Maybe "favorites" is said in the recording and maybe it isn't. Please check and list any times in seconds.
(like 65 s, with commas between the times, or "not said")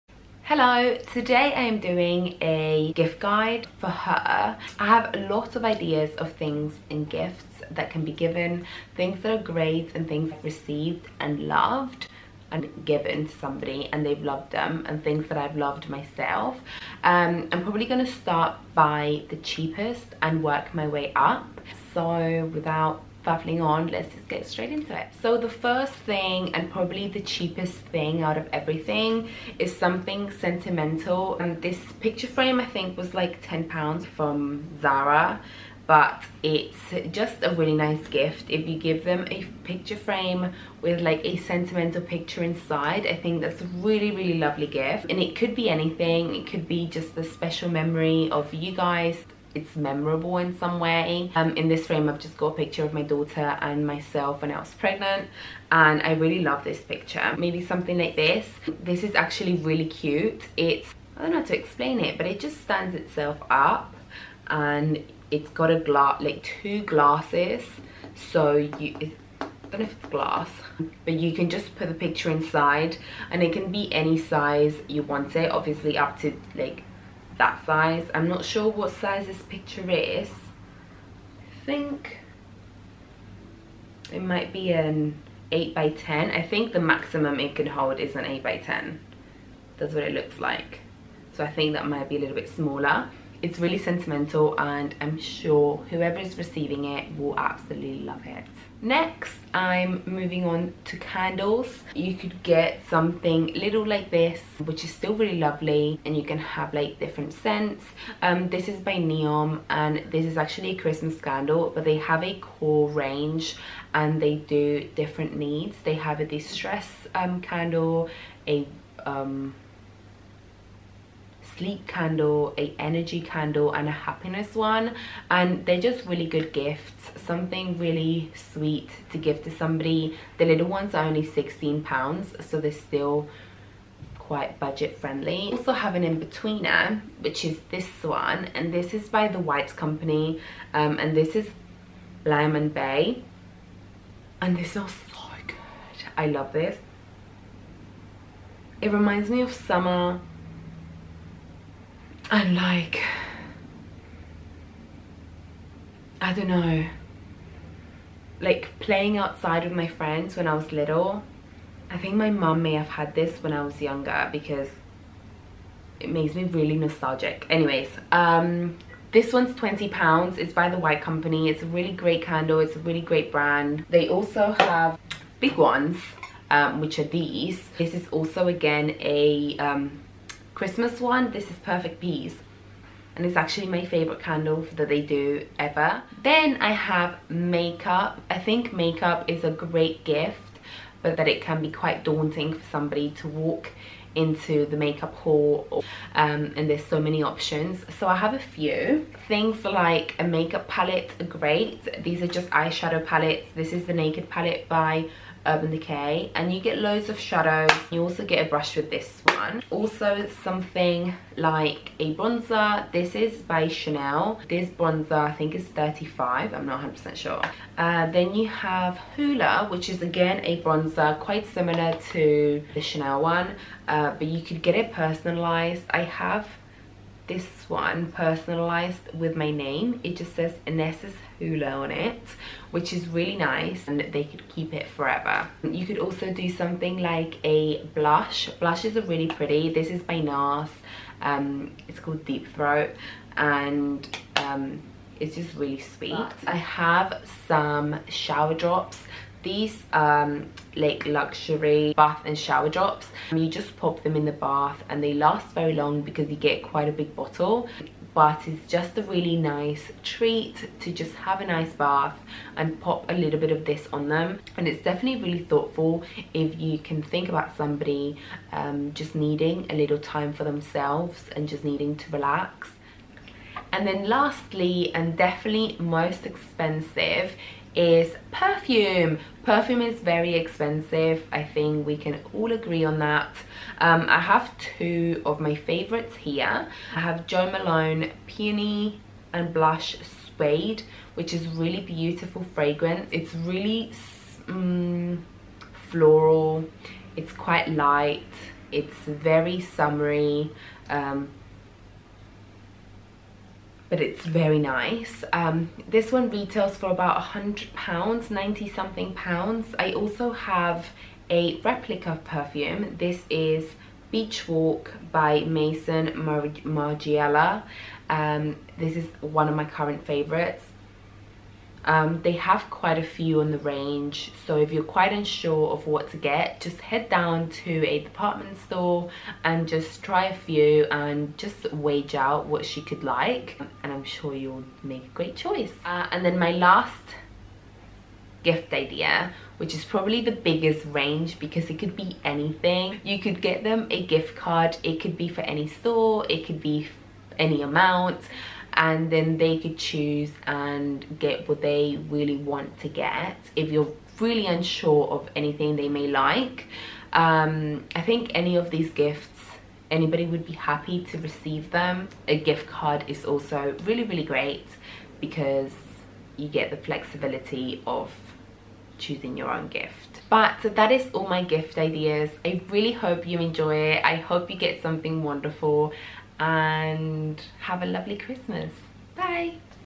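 183 s, 285 s, 320 s.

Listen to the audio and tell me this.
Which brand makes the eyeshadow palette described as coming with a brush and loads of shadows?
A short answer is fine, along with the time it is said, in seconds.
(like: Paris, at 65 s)
Urban Decay, at 205 s.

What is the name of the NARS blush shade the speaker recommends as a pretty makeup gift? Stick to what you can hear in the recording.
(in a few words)
Deep Throat.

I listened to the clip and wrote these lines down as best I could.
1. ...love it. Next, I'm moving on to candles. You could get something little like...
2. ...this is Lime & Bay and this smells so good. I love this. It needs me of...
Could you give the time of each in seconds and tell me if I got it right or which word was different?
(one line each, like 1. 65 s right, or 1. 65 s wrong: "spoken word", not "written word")
1. 98 s right
2. 141 s wrong: "reminds", not "needs".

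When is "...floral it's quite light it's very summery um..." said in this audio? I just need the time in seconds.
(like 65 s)
295 s.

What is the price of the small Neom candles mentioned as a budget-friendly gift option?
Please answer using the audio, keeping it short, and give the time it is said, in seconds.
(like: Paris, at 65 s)
16 pounds, at 131 s.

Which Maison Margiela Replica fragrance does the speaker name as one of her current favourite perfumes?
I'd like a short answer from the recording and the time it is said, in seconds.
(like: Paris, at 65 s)
Beach Walk, at 314 s.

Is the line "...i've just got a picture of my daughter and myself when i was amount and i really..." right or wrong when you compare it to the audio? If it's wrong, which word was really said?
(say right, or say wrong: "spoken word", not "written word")
wrong: "pregnant", not "amount".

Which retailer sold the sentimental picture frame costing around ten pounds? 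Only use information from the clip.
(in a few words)
Zara.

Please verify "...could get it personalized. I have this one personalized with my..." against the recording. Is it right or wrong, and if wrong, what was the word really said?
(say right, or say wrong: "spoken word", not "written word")
right.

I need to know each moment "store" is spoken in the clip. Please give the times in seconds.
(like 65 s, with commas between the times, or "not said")
328 s, 345 s.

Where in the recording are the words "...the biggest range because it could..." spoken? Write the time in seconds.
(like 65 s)
340 s.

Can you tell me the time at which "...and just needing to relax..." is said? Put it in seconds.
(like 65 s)
271 s.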